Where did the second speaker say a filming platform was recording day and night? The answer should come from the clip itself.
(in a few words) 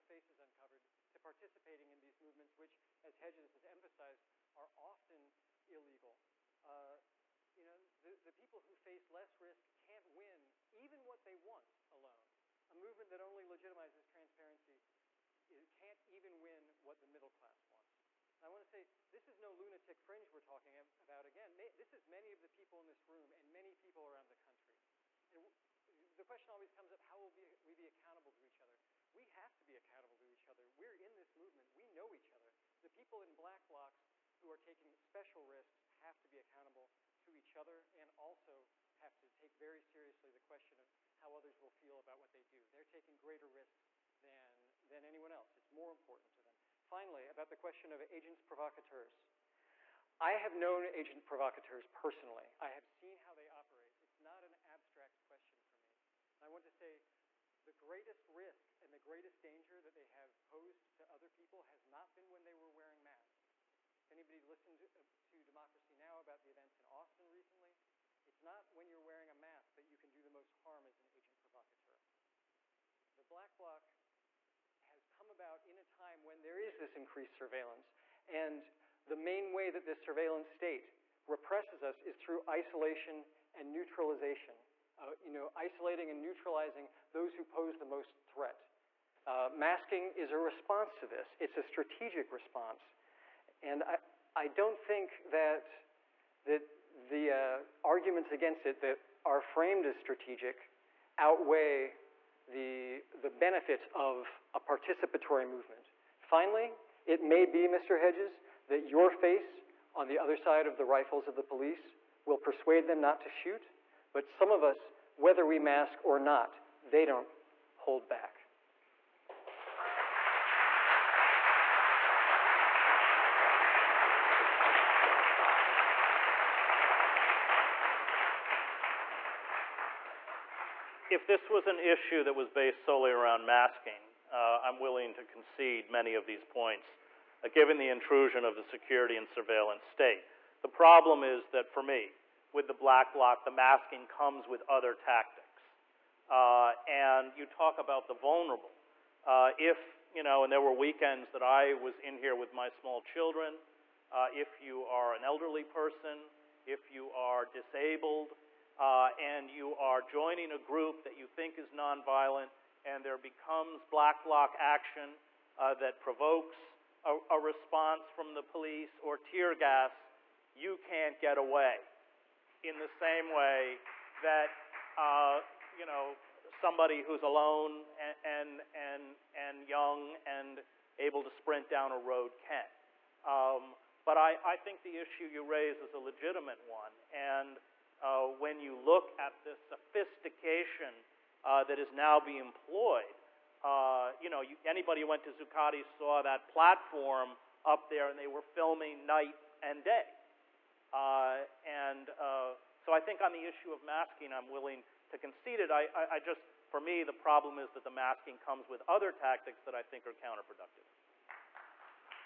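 Zuccotti.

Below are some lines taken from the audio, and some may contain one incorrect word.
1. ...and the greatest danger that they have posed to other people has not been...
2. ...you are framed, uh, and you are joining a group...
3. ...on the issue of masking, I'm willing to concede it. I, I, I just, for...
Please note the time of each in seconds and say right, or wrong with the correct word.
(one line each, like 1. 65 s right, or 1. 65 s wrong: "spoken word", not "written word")
1. 58 s right
2. 156 s wrong: "disabled", not "framed"
3. 203 s right.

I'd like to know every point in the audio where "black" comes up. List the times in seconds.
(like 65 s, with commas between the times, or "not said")
33 s, 73 s, 142 s, 163 s.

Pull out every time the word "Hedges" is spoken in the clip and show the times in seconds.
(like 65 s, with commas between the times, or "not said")
3 s, 107 s.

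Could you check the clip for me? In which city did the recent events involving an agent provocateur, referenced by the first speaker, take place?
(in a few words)
Austin.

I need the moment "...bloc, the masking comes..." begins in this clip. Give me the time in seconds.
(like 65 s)
143 s.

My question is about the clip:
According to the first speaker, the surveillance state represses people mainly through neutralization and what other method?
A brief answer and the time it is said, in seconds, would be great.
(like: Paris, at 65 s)
Isolation, at 82 s.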